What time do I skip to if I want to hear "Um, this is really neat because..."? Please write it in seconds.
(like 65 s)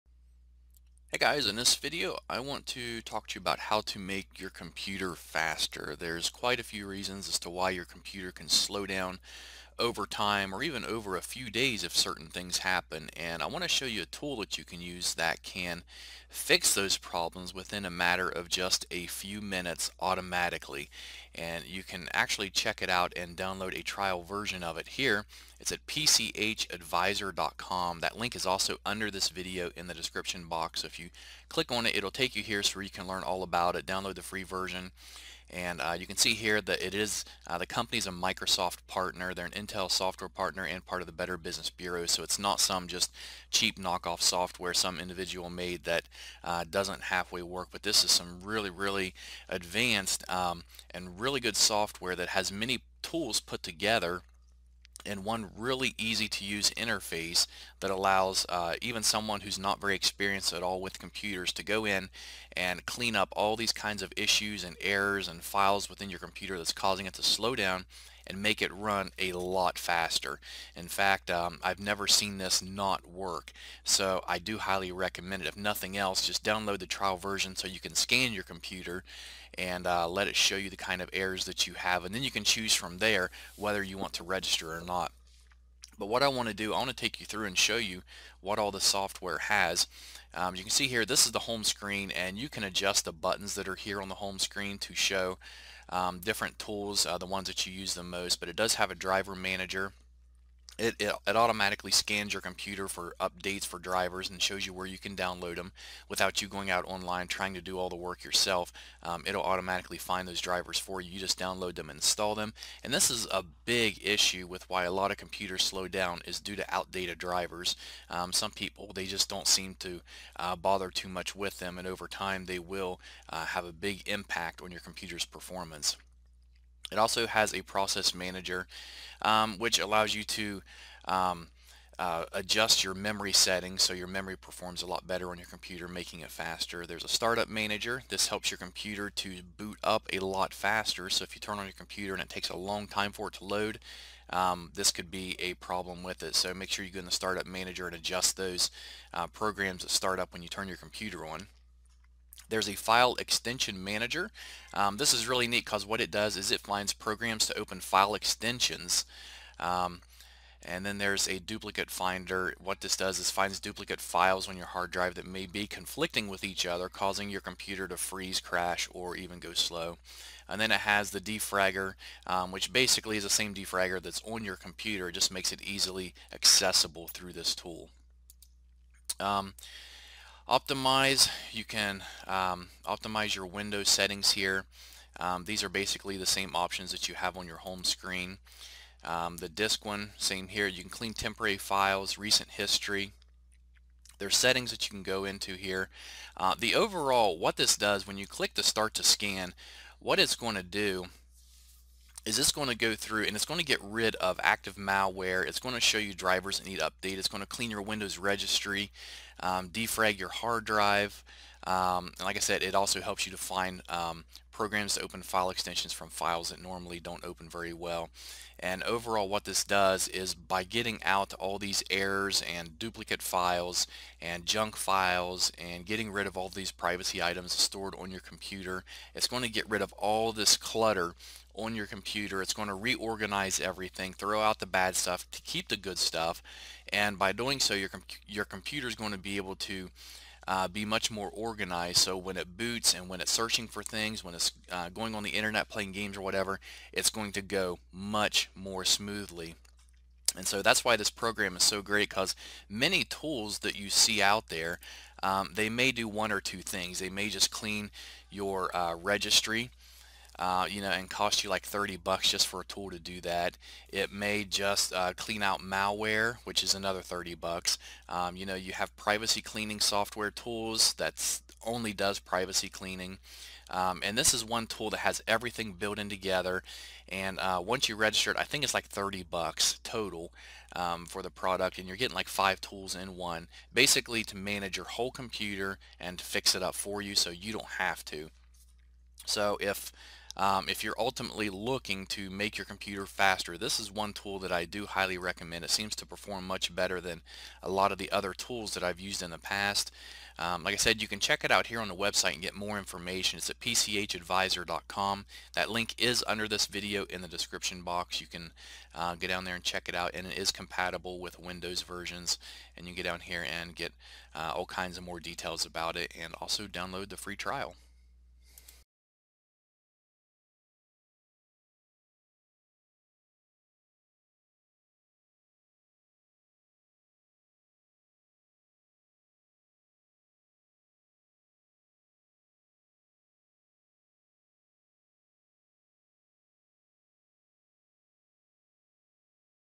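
154 s.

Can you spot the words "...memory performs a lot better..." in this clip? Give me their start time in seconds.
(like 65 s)
134 s.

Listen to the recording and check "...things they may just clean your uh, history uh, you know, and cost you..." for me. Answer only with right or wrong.
wrong.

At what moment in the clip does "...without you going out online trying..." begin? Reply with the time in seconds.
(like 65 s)
106 s.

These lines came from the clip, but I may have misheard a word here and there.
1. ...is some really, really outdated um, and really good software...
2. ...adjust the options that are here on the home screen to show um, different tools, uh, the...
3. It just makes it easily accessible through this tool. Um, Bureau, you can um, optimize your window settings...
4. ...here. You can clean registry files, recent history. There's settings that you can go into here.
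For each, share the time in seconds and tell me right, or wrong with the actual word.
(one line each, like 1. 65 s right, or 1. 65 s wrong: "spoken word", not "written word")
1. 48 s wrong: "advanced", not "outdated"
2. 92 s wrong: "buttons", not "options"
3. 175 s wrong: "Optimize", not "Bureau"
4. 190 s wrong: "temporary", not "registry".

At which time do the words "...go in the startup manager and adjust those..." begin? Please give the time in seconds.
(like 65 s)
146 s.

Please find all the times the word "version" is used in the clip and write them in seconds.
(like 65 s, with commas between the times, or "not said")
24 s, 34 s, 77 s, 311 s.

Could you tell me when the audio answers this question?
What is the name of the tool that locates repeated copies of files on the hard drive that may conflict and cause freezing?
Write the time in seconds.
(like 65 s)
161 s.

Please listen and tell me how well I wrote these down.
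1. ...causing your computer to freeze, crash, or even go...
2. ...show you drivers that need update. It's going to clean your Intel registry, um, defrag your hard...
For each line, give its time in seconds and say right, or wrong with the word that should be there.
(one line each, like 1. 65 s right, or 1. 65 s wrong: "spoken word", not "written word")
1. 166 s right
2. 205 s wrong: "Windows", not "Intel".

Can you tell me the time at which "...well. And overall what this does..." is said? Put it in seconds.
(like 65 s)
217 s.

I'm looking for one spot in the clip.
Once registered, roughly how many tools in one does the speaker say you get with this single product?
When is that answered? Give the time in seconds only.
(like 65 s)
282 s.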